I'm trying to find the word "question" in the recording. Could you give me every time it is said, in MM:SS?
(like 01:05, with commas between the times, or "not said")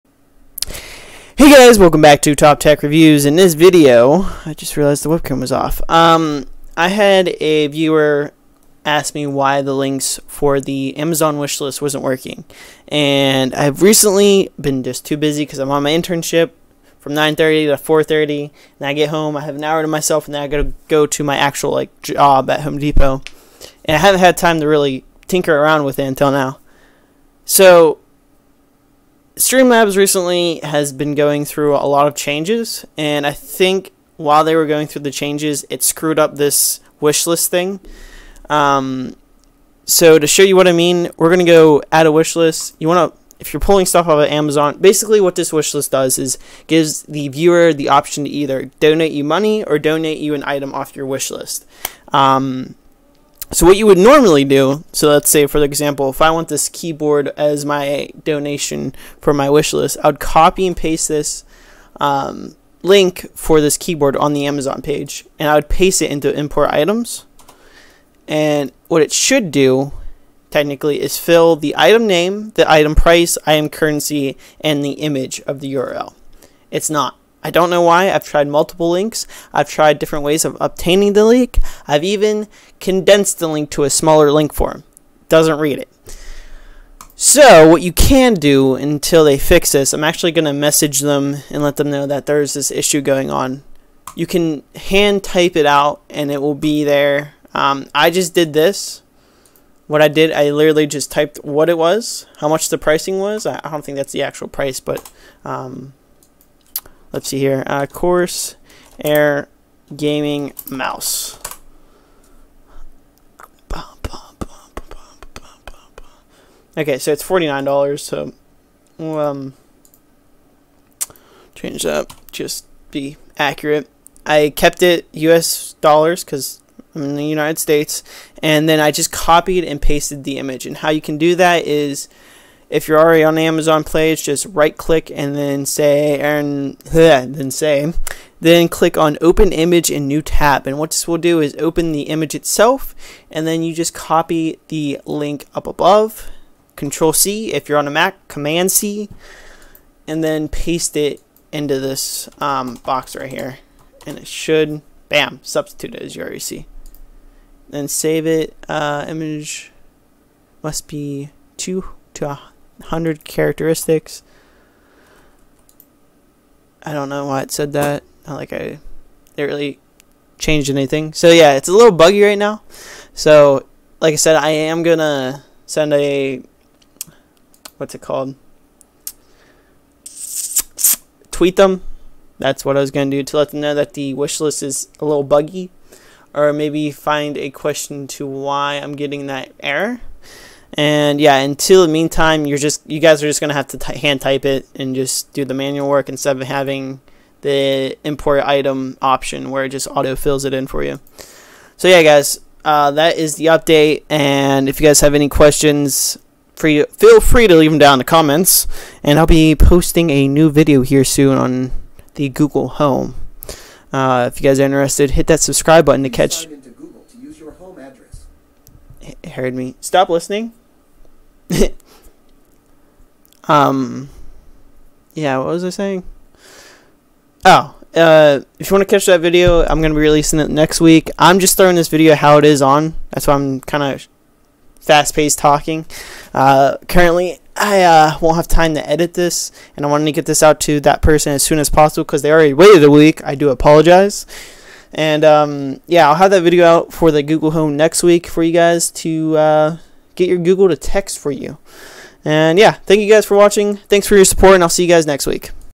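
03:07, 03:25.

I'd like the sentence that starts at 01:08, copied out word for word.
And what it should do, technically, is fill the item name, the item price, item currency, and the image of the URL.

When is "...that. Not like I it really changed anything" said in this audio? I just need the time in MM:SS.
02:47.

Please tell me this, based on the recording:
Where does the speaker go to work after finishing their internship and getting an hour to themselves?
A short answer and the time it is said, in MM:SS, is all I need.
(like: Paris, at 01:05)
Home Depot, at 00:22.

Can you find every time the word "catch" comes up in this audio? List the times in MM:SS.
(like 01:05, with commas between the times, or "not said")
03:36, 03:48.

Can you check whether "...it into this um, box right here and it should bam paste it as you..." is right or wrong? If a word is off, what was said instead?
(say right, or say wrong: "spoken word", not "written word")
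wrong: "substitute", not "paste".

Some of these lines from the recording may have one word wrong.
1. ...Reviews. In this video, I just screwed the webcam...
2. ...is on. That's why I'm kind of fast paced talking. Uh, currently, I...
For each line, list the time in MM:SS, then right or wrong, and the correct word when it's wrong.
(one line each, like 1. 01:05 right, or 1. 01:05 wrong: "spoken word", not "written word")
1. 00:02 wrong: "realized", not "screwed"
2. 03:52 right.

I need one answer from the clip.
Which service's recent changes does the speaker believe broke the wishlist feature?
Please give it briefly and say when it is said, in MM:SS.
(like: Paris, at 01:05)
Streamlabs, at 00:29.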